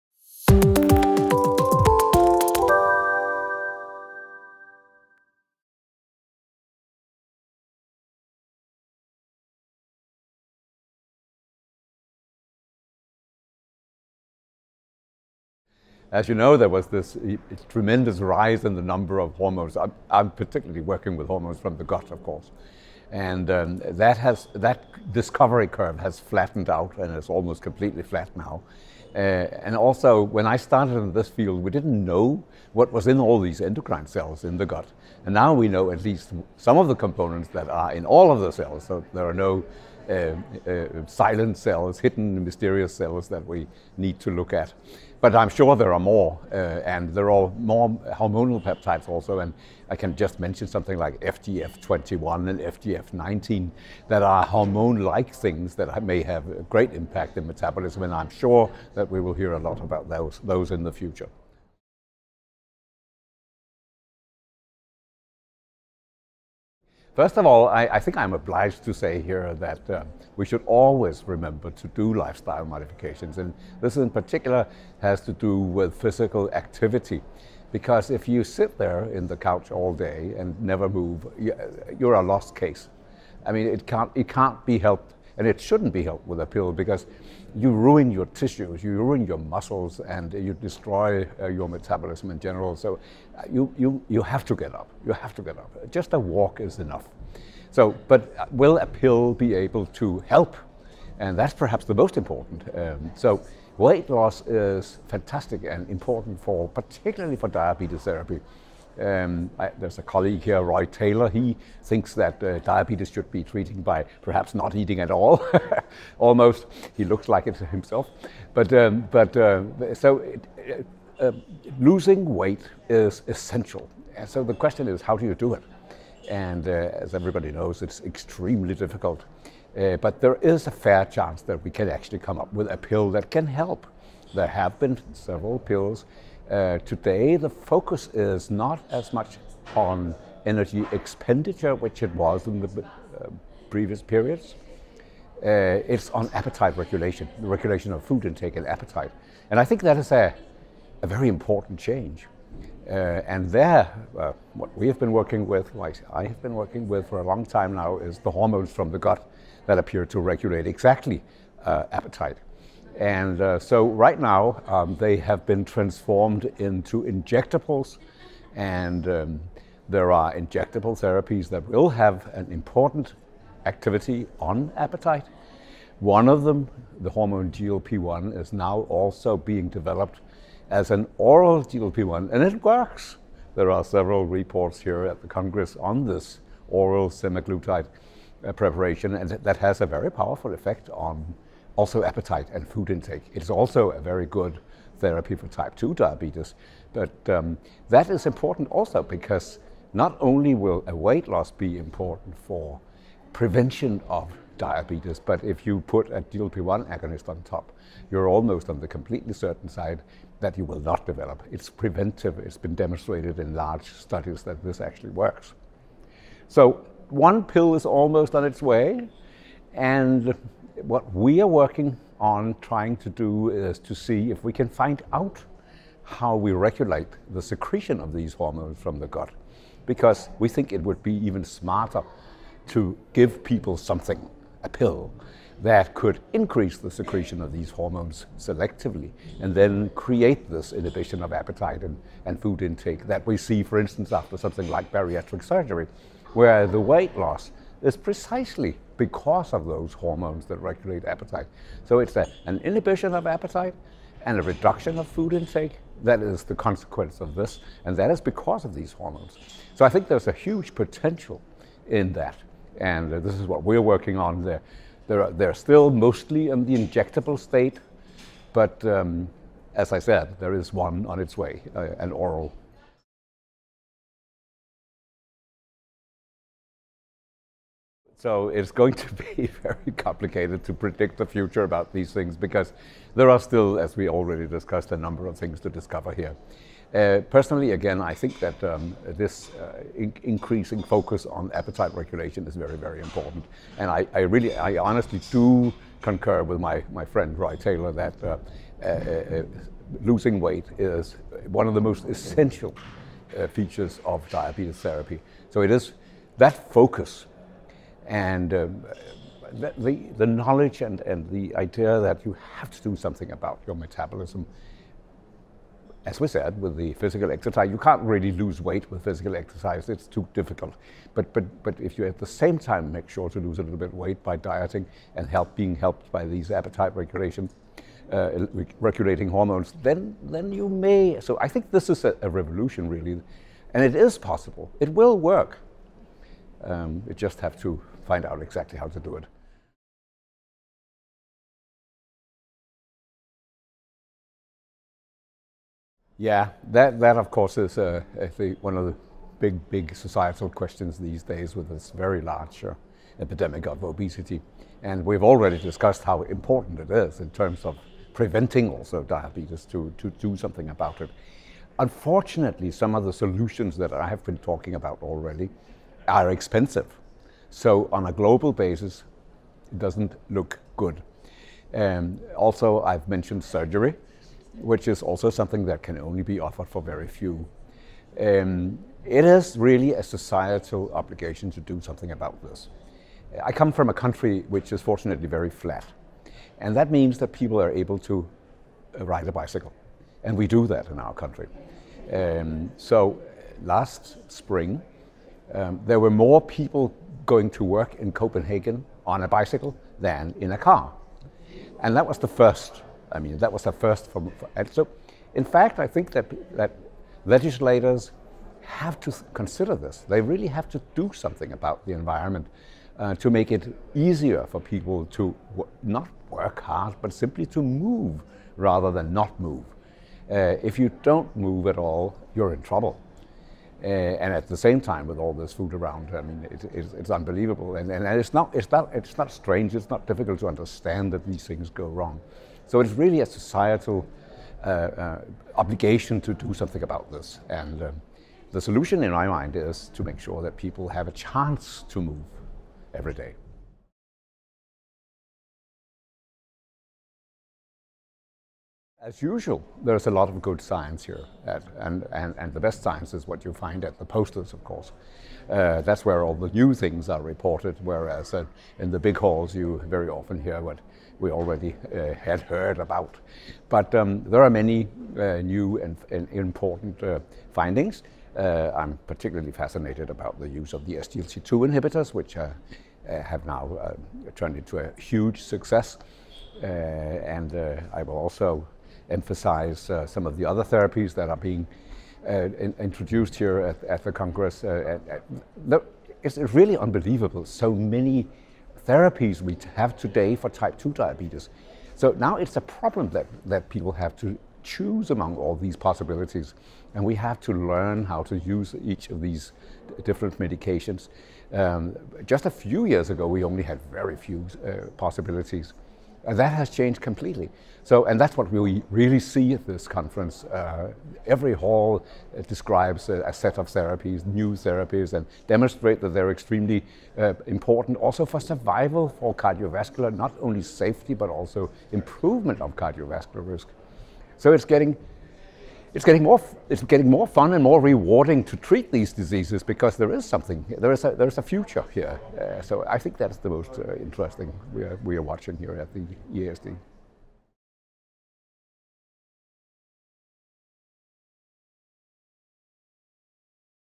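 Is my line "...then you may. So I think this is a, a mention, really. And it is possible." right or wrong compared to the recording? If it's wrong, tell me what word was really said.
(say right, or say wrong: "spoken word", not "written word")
wrong: "revolution", not "mention".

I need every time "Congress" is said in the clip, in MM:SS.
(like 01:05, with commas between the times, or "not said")
03:05, 08:04.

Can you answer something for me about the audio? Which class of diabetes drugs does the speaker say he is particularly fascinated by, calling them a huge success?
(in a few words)
SGLT2 inhibitors.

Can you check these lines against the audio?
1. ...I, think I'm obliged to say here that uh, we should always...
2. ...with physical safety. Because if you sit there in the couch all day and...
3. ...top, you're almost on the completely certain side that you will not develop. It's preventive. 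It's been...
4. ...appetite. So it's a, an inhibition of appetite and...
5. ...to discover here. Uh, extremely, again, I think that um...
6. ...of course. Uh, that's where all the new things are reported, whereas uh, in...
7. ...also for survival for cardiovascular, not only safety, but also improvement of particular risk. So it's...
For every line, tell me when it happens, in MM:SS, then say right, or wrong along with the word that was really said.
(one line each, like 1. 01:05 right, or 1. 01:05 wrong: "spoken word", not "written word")
1. 01:07 right
2. 01:15 wrong: "activity", not "safety"
3. 03:27 right
4. 04:11 right
5. 04:45 wrong: "personally", not "extremely"
6. 07:34 right
7. 08:37 wrong: "cardiovascular", not "particular".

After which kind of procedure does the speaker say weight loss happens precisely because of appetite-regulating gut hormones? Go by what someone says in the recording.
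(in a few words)
bariatric surgery.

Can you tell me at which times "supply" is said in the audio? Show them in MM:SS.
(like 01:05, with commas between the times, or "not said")
not said.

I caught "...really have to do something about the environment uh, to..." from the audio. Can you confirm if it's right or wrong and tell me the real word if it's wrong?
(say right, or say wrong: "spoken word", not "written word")
right.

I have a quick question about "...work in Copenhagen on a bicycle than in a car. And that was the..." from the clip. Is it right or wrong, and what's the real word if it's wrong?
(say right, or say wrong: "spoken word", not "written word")
right.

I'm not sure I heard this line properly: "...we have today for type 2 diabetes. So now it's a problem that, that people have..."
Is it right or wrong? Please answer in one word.
right.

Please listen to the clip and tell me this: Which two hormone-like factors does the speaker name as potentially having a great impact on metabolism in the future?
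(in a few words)
FGF21 and FGF19.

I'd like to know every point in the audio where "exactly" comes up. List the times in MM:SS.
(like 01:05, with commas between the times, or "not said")
02:40, 05:38.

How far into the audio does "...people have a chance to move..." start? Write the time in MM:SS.
07:20.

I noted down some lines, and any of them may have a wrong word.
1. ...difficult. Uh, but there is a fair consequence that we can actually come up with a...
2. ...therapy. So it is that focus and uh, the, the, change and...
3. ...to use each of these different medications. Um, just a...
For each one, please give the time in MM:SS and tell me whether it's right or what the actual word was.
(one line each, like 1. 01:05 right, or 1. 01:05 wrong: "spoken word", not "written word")
1. 02:08 wrong: "chance", not "consequence"
2. 05:04 wrong: "knowledge", not "change"
3. 08:18 right.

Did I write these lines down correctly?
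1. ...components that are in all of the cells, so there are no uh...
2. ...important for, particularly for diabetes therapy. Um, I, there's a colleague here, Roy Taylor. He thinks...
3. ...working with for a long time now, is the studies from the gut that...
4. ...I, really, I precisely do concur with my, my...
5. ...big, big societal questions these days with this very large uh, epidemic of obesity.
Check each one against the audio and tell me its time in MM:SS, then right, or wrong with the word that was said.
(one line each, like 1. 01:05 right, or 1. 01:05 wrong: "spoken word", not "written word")
1. 00:36 right
2. 01:45 right
3. 02:36 wrong: "hormones", not "studies"
4. 04:54 wrong: "honestly", not "precisely"
5. 05:49 right.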